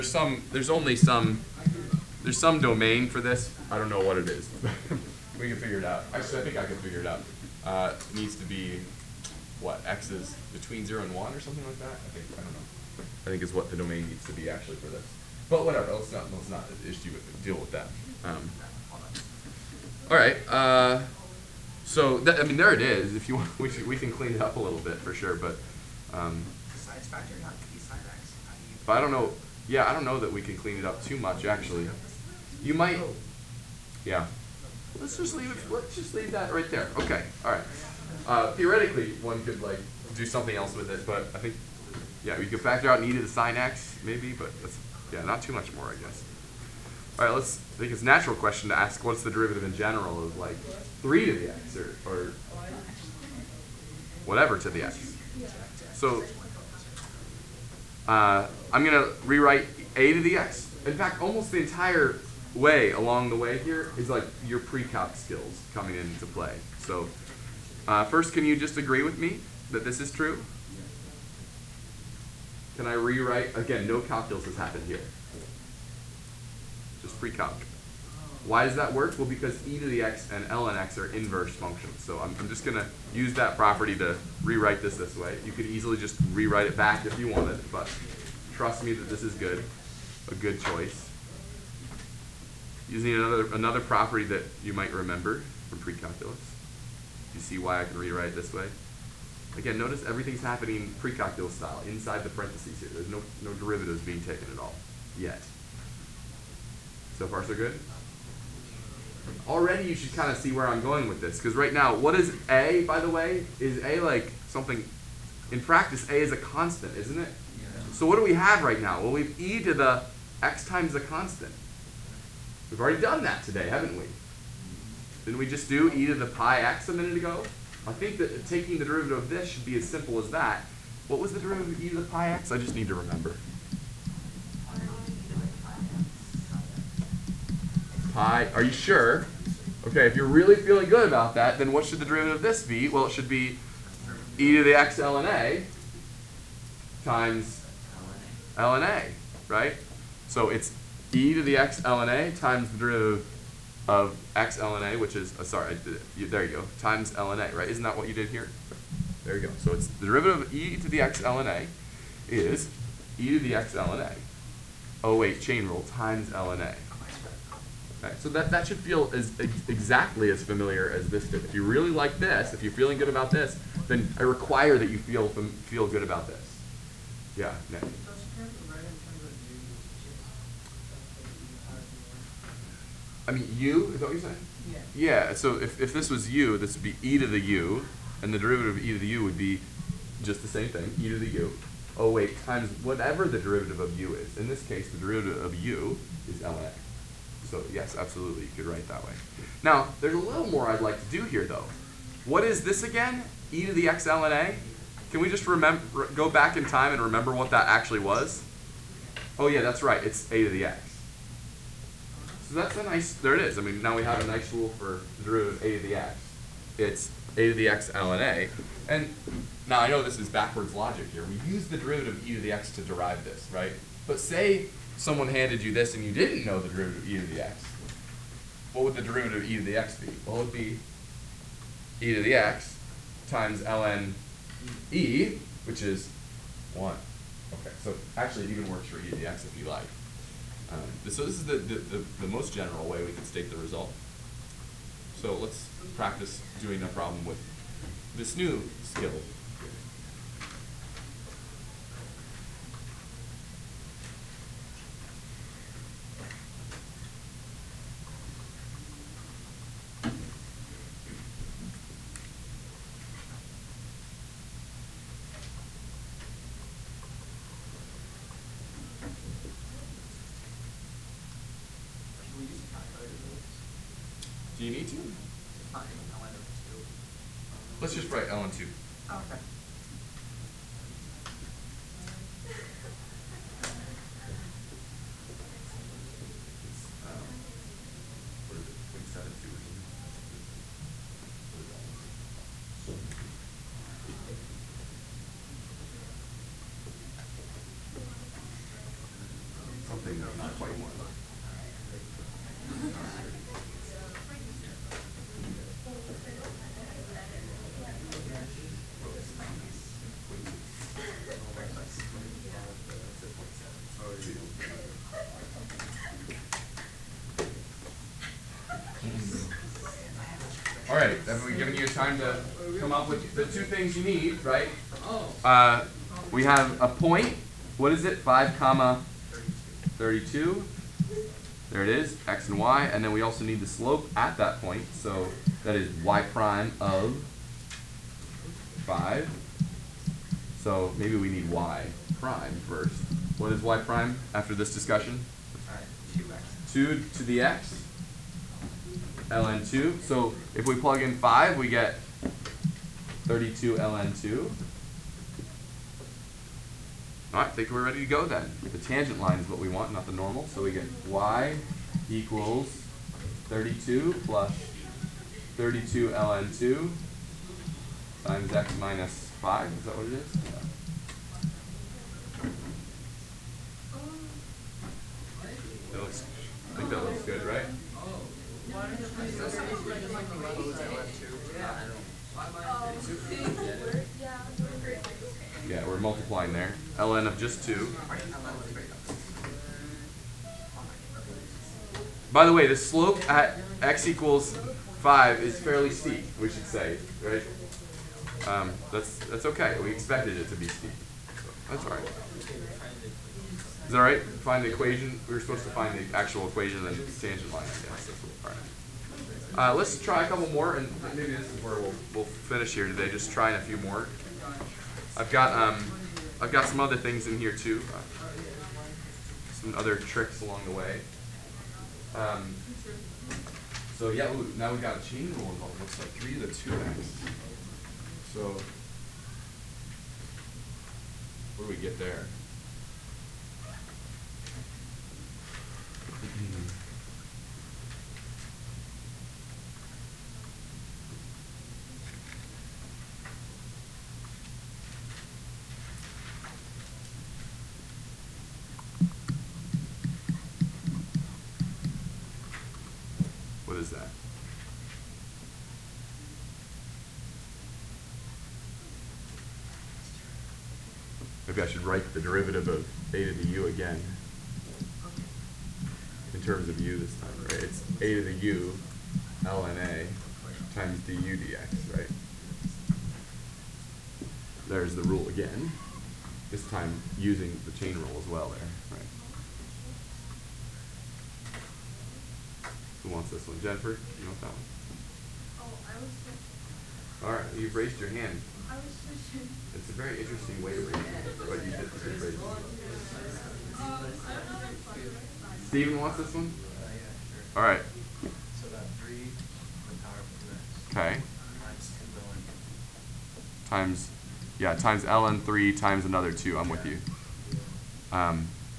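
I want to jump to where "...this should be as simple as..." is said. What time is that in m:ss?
2:09.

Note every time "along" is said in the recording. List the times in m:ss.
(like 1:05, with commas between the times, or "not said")
1:02, 7:00.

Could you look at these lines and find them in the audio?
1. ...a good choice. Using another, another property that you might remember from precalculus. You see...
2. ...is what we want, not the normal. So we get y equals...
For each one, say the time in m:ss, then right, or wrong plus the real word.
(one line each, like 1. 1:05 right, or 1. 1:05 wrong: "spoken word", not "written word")
1. 1:30 right
2. 5:59 right.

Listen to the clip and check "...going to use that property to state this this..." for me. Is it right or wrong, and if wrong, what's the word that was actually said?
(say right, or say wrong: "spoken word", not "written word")
wrong: "rewrite", not "state".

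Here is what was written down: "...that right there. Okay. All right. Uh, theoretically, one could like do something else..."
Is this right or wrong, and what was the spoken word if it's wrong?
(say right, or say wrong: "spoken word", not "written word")
right.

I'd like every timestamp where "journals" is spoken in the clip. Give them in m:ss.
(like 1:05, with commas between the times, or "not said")
not said.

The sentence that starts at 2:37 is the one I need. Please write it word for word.
Isn't that what you did here?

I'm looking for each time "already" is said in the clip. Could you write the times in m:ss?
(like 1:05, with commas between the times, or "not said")
1:49, 2:02.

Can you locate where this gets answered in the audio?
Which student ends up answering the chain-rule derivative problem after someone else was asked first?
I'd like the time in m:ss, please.
8:15.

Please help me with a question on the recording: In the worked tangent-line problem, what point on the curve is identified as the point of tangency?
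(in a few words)
(5, 32).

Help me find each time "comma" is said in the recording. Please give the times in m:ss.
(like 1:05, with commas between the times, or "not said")
5:28.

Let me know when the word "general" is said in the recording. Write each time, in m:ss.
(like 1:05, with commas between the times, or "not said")
0:49, 4:02.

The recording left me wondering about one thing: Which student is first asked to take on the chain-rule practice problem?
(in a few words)
Jennifer.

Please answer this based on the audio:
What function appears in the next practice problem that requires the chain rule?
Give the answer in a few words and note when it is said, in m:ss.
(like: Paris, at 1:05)
3 to the 2x, at 7:06.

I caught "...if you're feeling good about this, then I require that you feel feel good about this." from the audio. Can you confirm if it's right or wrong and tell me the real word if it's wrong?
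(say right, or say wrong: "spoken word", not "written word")
right.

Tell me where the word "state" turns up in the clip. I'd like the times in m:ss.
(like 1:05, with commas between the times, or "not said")
4:03.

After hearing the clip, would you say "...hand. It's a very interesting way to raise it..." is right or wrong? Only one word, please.
right.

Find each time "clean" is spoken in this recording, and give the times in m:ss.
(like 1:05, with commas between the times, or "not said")
0:24, 0:30.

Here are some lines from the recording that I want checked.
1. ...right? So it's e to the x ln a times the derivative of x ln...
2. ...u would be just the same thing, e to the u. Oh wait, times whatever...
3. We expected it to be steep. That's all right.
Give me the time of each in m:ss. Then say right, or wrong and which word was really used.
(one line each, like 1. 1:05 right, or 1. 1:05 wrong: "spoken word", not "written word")
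1. 2:29 right
2. 3:09 right
3. 6:39 right.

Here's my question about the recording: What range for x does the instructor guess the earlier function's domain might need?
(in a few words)
between 0 and 1.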